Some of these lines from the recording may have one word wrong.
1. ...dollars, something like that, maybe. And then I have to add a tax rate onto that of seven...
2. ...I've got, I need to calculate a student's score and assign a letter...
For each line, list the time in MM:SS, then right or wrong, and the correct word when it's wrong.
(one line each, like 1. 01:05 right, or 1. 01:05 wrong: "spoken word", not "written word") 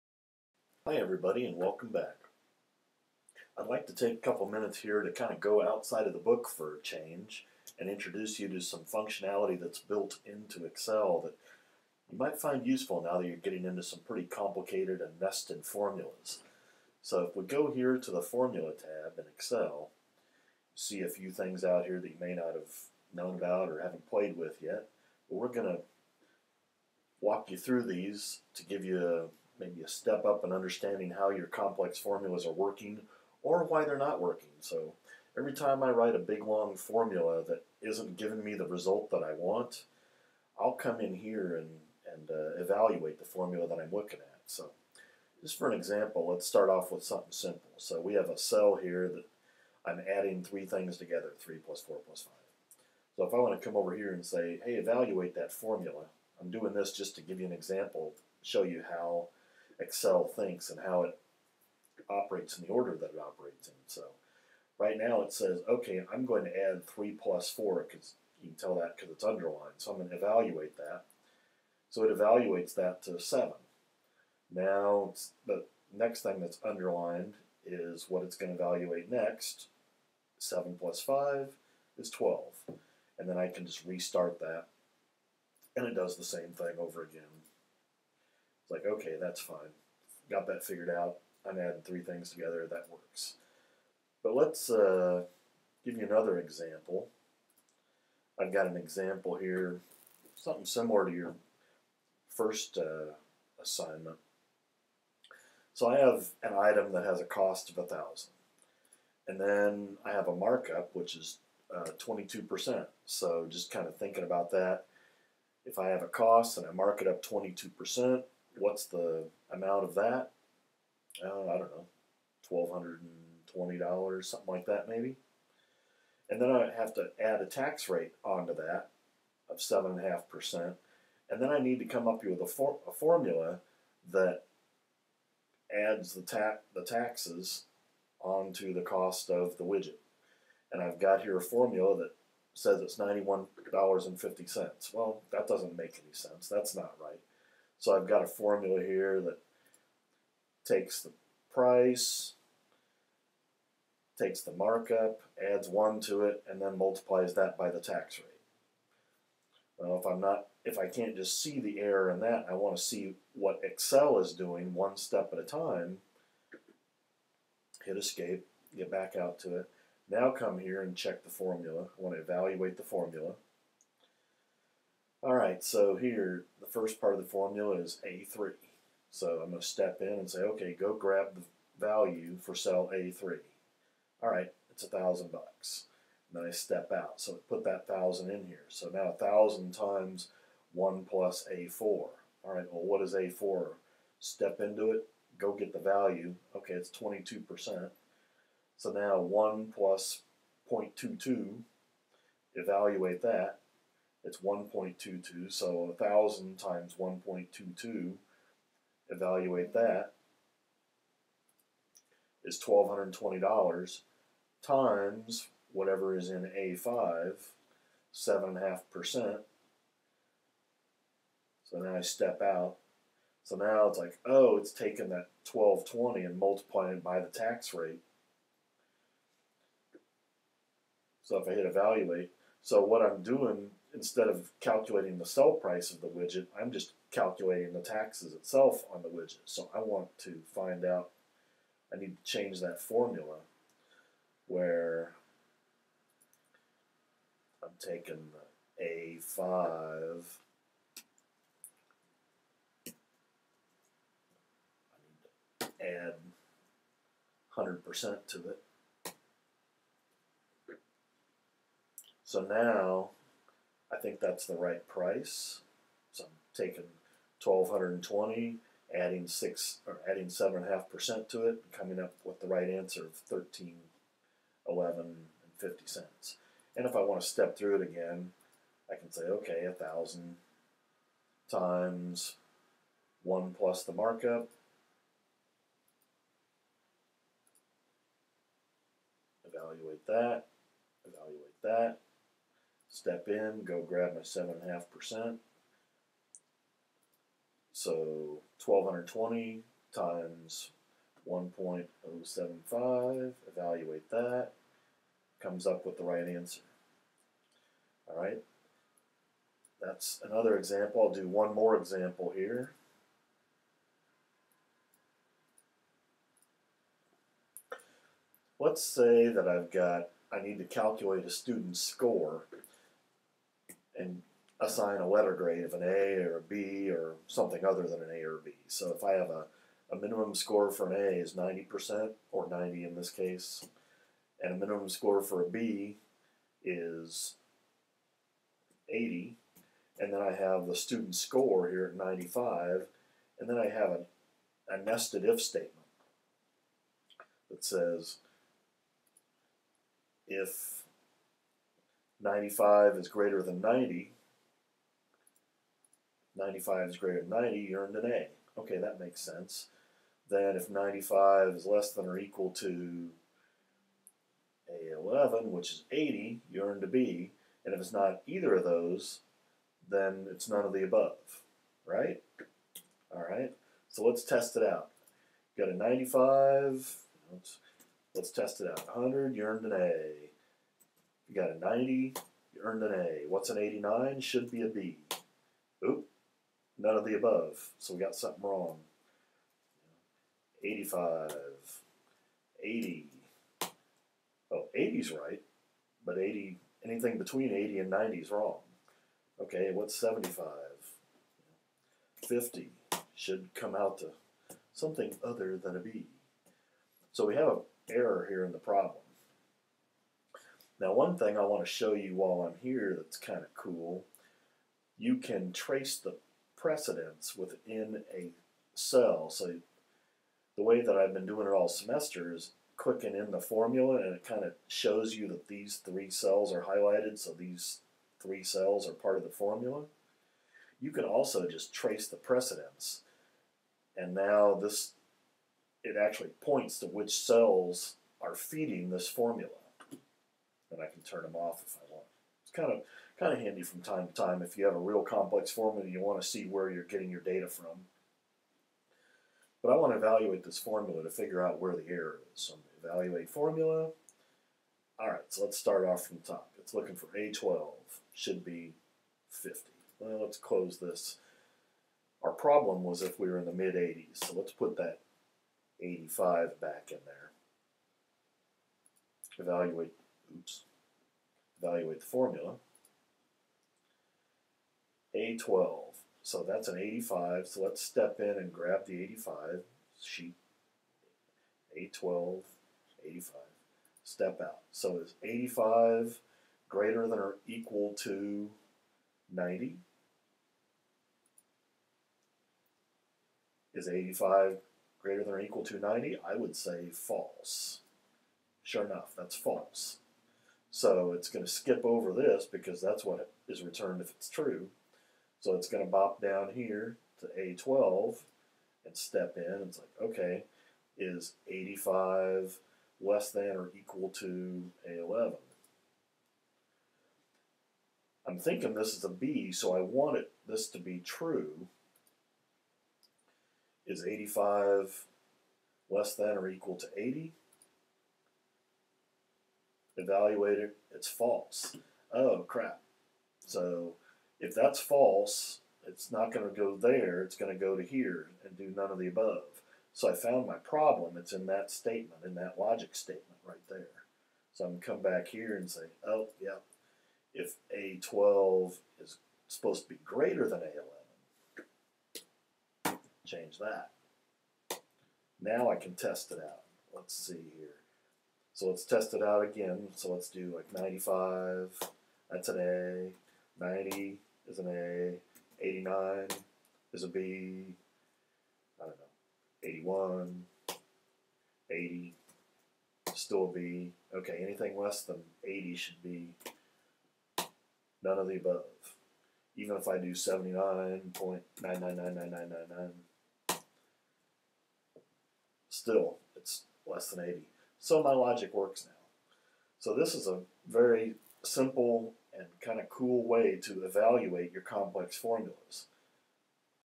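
1. 02:03 right
2. 05:19 right.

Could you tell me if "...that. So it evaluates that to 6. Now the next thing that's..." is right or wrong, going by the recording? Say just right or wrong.
wrong.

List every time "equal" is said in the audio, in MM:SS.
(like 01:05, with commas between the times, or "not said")
06:02, 08:07, 08:15, 08:33, 08:46.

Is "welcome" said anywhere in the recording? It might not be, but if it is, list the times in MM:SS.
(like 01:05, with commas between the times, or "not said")
00:01.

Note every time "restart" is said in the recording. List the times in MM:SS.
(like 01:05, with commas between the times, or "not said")
01:23.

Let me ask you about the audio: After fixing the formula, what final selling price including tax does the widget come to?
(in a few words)
$1,311.50.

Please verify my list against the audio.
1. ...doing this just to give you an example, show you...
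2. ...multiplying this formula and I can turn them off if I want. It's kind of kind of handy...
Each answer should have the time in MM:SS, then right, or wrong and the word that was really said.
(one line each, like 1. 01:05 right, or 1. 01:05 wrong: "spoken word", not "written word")
1. 00:56 right
2. 07:18 wrong: "feeding", not "multiplying".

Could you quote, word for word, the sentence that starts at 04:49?
Evaluate that, evaluate that, step in, go grab my 7.5%.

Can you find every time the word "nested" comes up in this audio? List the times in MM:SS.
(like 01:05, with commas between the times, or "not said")
00:15, 05:44.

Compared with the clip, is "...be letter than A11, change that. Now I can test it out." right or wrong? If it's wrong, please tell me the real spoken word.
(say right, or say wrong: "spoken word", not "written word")
wrong: "greater", not "letter".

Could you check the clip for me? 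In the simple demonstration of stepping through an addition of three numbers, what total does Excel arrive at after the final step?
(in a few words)
12.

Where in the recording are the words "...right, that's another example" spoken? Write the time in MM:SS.
05:08.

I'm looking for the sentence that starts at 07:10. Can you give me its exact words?
You can also just trace the precedents.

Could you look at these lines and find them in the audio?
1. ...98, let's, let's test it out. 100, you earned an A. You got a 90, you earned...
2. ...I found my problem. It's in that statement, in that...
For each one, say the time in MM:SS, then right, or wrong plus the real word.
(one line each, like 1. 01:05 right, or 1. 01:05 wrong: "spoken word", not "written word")
1. 06:15 wrong: "95", not "98"
2. 09:00 right.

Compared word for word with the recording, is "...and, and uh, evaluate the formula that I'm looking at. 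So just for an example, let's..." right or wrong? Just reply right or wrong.
right.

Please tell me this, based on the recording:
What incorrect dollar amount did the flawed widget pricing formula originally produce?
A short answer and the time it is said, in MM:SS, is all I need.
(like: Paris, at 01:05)
$91.50, at 02:22.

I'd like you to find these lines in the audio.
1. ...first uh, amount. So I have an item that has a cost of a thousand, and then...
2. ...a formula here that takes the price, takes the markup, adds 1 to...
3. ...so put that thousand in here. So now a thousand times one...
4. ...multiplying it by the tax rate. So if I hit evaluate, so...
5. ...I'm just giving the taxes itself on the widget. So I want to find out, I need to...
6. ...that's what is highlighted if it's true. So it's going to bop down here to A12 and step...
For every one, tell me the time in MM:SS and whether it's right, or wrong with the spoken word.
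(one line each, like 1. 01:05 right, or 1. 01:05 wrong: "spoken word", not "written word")
1. 01:42 wrong: "assignment", not "amount"
2. 02:28 right
3. 03:07 right
4. 03:46 right
5. 03:56 wrong: "calculating", not "giving"
6. 08:22 wrong: "returned", not "highlighted".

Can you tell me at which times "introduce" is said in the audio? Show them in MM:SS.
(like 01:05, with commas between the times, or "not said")
00:07.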